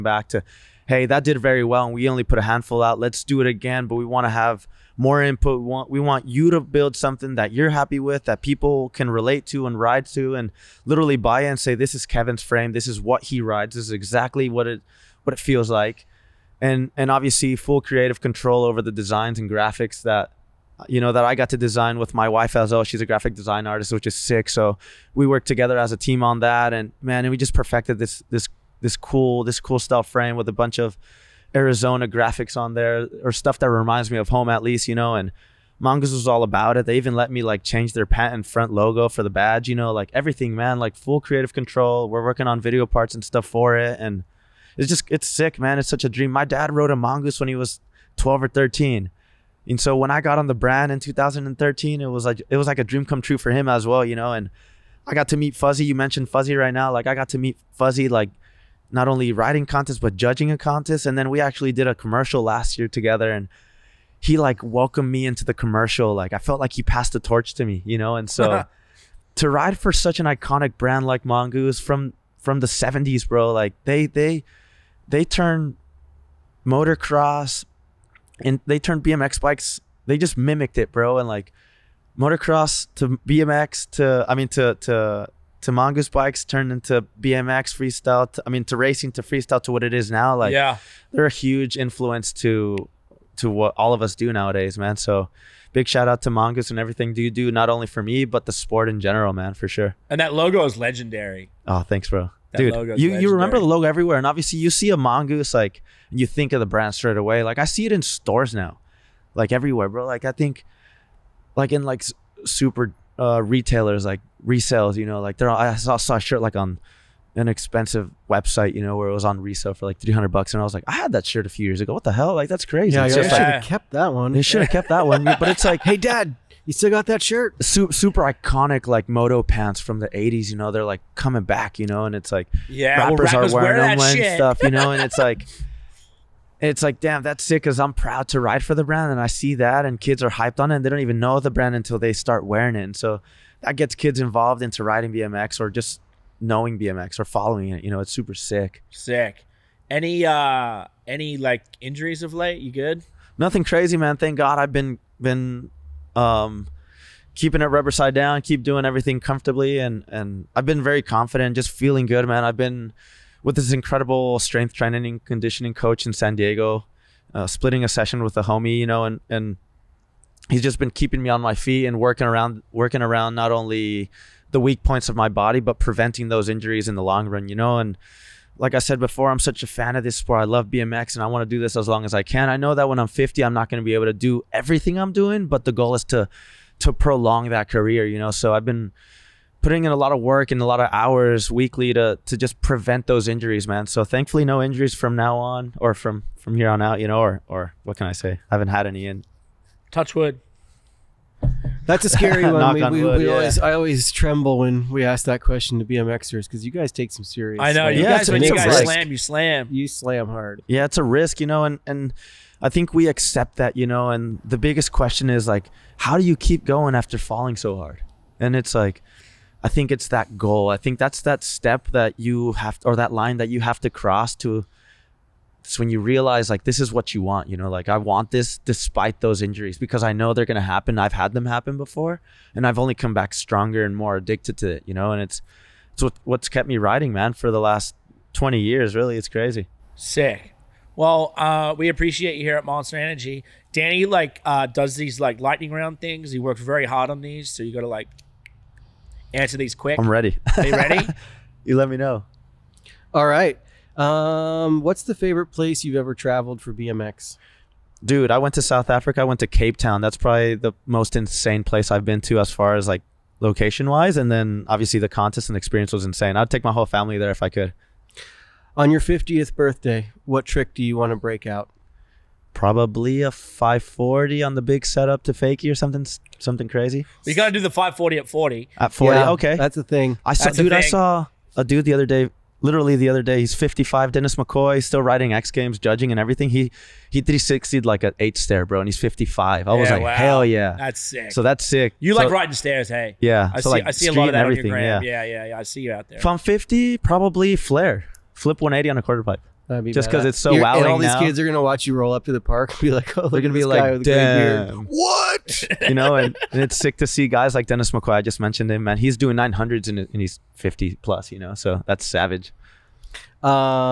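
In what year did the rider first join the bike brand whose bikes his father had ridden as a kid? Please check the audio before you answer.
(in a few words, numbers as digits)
2013.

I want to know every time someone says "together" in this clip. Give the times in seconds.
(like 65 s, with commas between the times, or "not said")
25 s, 62 s.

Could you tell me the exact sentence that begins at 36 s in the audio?
They even let me like change their patent front logo for the badge, you know, like everything, man, like full creative control.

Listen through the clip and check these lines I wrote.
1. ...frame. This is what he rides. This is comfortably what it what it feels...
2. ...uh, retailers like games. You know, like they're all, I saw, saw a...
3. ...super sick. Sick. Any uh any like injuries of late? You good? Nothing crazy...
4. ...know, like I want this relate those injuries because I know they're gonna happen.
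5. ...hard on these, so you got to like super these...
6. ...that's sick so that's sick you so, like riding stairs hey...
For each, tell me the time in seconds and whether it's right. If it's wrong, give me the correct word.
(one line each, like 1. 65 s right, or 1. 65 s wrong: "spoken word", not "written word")
1. 12 s wrong: "exactly", not "comfortably"
2. 113 s wrong: "resales", not "games"
3. 148 s right
4. 227 s wrong: "despite", not "relate"
5. 246 s wrong: "answer", not "super"
6. 290 s right.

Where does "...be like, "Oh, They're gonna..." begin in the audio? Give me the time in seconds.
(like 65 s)
302 s.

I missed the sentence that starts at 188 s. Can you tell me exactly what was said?
So I've been putting in a lot of work and a lot of hours weekly to to just prevent those injuries, man.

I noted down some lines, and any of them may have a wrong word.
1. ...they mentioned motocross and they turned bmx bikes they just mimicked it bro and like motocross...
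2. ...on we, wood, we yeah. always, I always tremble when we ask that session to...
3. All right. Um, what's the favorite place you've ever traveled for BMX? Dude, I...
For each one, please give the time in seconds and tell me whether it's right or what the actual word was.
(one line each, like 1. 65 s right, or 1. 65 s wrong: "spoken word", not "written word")
1. 75 s wrong: "turned", not "mentioned"
2. 202 s wrong: "question", not "session"
3. 253 s right.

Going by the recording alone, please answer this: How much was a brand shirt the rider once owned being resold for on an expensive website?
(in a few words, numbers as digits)
$300.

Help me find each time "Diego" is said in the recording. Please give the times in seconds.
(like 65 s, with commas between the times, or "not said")
166 s.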